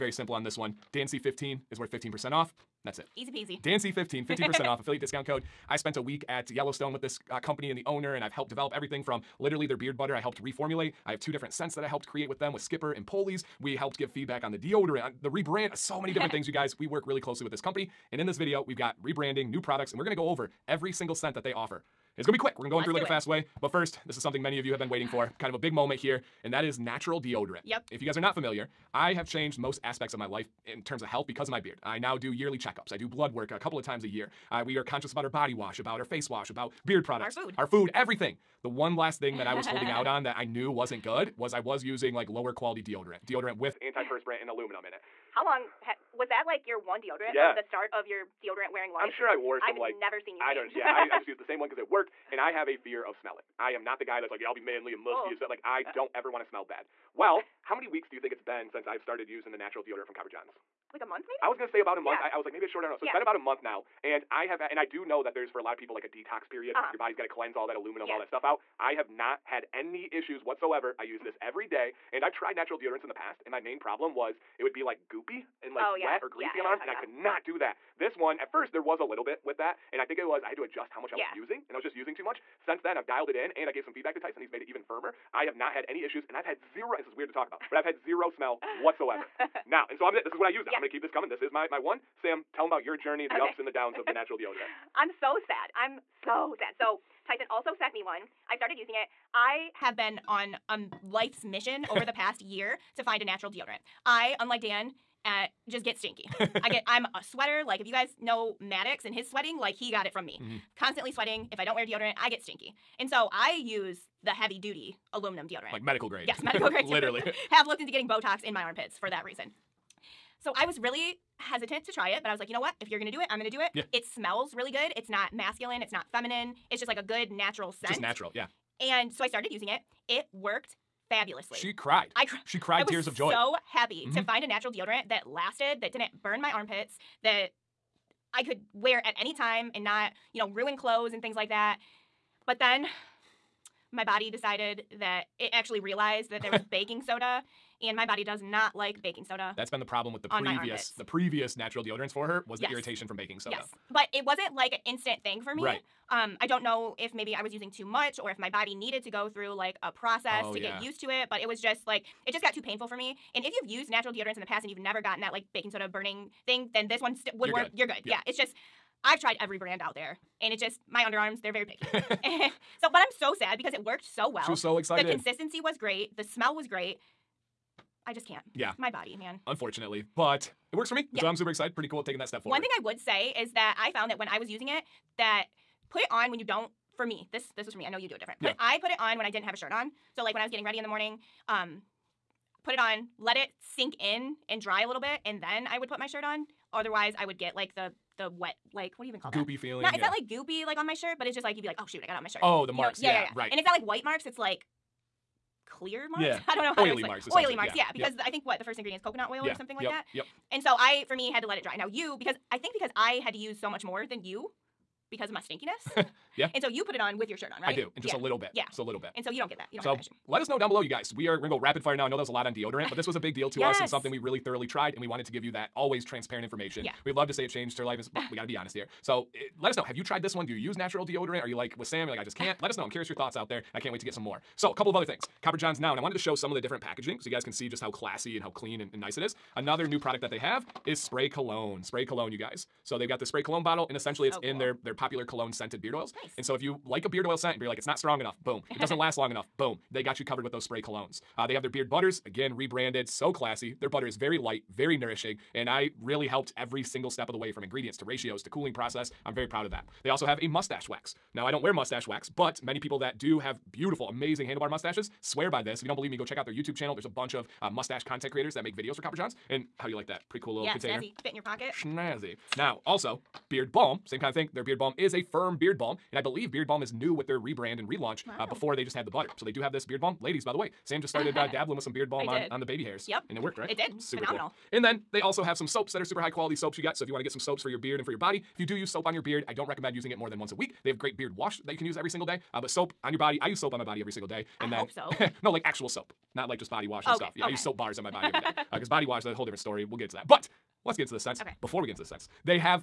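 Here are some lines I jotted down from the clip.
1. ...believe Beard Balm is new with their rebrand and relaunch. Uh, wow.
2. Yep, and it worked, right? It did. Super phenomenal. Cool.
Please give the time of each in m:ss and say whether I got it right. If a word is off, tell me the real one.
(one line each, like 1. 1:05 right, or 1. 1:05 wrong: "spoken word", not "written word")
1. 4:36 right
2. 4:43 right.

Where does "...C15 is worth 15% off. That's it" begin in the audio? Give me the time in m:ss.
0:01.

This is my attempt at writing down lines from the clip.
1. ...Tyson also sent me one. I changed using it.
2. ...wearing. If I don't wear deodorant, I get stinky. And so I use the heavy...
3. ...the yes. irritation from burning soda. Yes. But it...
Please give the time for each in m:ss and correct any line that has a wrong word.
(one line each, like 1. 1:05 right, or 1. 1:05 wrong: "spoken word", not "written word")
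1. 1:37 wrong: "started", not "changed"
2. 1:51 wrong: "sweating", not "wearing"
3. 2:32 wrong: "baking", not "burning".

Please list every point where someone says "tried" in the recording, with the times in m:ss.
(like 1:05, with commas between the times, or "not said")
1:12, 2:49, 3:44, 3:50.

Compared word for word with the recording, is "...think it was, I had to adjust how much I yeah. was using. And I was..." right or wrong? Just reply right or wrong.
right.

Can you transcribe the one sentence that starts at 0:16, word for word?
We work really closely with this company.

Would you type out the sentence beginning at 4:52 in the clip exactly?
Uh, but soap on your body, I use soap on my body every single day.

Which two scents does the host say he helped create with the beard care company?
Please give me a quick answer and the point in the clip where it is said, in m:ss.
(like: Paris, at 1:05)
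Skipper and Polys, at 0:12.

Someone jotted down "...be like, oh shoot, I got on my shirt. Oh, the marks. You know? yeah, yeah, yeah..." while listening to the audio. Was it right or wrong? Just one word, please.
right.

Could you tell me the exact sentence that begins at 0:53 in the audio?
I am not the guy that's like, yeah, I'll be manly and musky oh.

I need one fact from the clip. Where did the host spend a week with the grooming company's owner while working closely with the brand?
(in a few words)
Yellowstone.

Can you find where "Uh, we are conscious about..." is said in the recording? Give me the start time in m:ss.
0:34.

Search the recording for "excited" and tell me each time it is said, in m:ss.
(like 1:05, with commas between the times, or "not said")
2:54, 3:01.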